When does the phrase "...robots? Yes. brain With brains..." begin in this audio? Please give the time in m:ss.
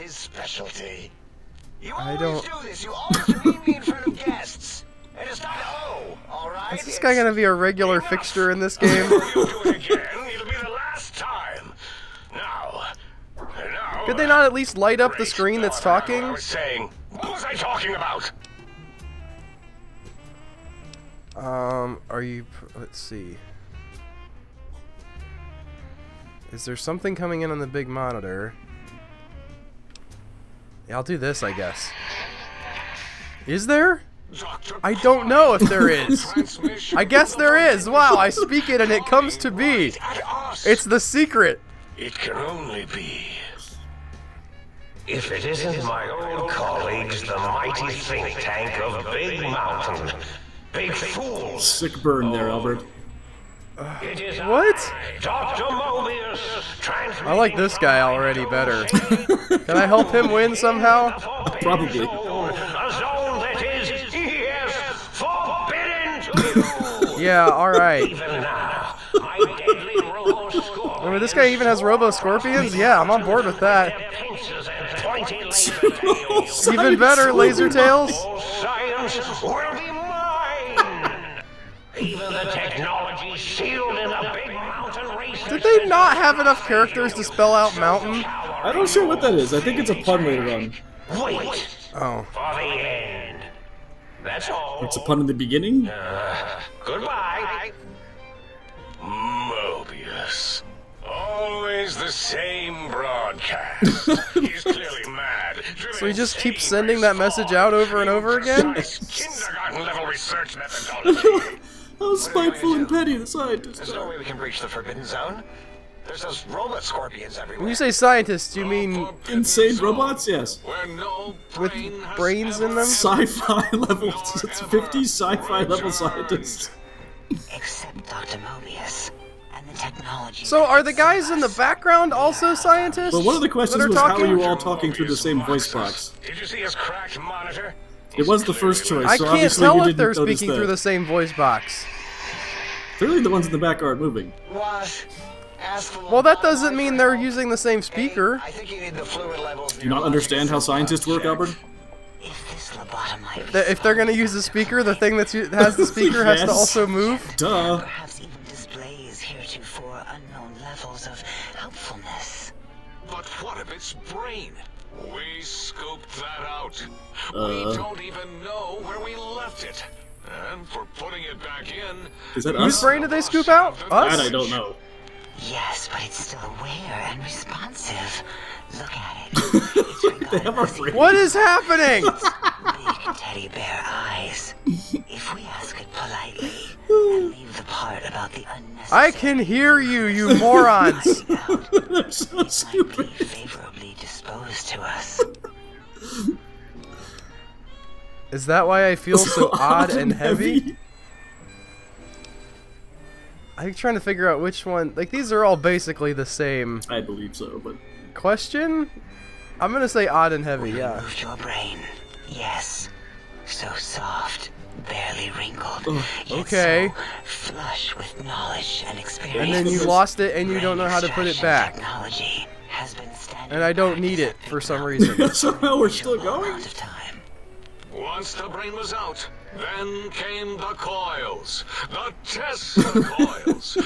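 1:59.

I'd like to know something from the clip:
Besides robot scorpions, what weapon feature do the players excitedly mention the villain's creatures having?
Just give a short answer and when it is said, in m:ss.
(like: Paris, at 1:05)
Laser Tails, at 1:17.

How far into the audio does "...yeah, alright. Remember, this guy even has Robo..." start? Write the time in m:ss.
1:07.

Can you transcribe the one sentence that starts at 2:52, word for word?
Is that Whose brain did they scoop out?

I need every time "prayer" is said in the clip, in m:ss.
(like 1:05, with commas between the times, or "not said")
not said.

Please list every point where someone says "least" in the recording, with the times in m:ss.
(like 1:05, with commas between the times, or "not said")
0:14.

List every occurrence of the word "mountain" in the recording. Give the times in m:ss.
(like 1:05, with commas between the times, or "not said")
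0:49, 1:27.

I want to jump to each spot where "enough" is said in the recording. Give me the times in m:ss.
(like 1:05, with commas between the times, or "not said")
0:07, 1:26.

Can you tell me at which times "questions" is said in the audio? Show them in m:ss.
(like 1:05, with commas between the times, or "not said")
2:13, 3:28.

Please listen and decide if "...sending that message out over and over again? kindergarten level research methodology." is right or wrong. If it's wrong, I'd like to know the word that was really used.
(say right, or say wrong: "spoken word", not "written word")
right.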